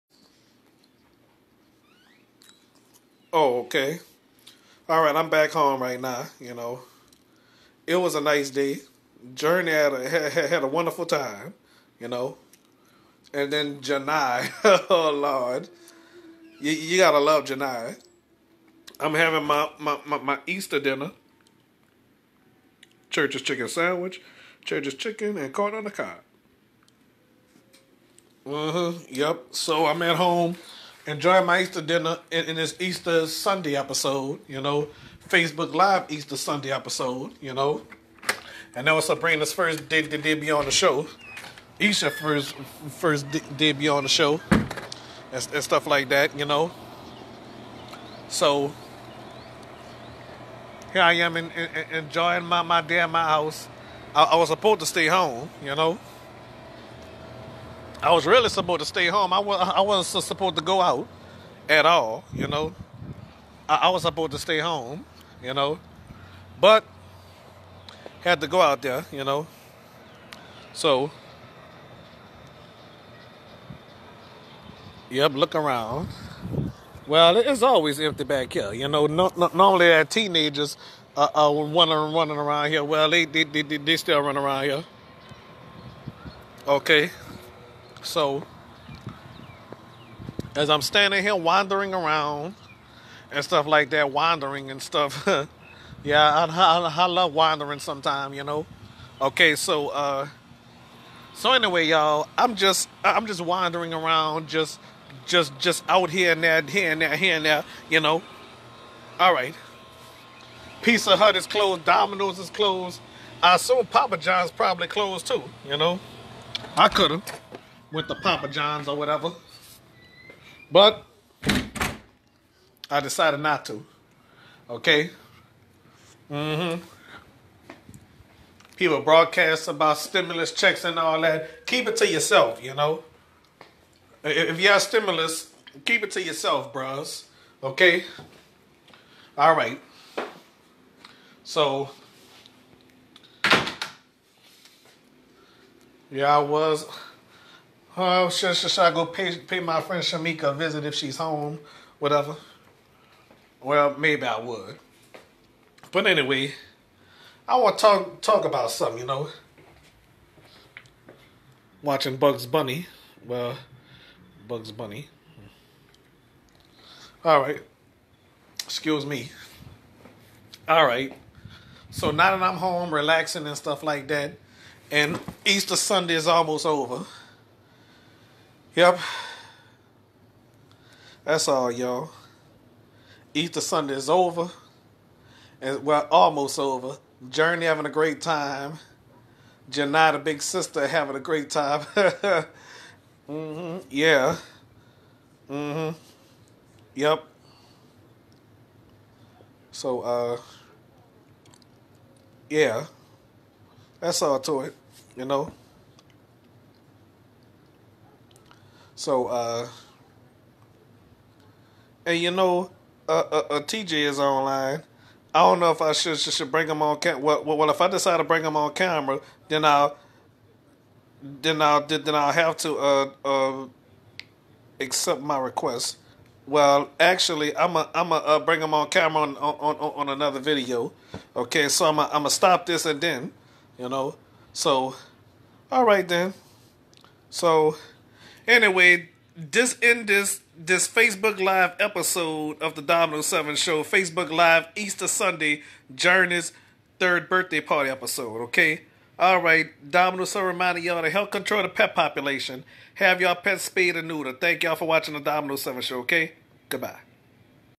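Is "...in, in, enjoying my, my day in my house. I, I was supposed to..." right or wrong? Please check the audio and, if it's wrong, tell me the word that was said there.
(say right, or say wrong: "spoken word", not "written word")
right.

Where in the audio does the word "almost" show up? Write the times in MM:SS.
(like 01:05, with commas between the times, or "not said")
02:56, 03:06.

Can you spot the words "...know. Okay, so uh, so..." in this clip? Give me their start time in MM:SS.
01:38.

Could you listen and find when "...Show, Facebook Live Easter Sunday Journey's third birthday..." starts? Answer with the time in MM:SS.
04:03.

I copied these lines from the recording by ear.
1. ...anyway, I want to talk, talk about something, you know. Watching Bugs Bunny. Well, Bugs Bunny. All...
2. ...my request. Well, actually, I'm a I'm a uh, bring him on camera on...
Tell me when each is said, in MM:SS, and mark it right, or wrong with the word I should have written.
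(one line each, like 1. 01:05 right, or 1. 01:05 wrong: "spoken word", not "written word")
1. 02:36 right
2. 03:45 right.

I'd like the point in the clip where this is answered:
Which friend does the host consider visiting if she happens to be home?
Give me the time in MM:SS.
02:30.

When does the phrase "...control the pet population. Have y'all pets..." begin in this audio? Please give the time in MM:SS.
04:11.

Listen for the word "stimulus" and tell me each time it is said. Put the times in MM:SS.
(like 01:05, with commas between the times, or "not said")
02:09, 02:14.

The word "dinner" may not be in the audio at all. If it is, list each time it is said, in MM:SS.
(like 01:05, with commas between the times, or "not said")
00:20, 00:31.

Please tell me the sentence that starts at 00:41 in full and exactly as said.
Isha first first de- debut on the show.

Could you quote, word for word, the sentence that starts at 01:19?
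No, no, normally, our teenagers are, are running, running around here.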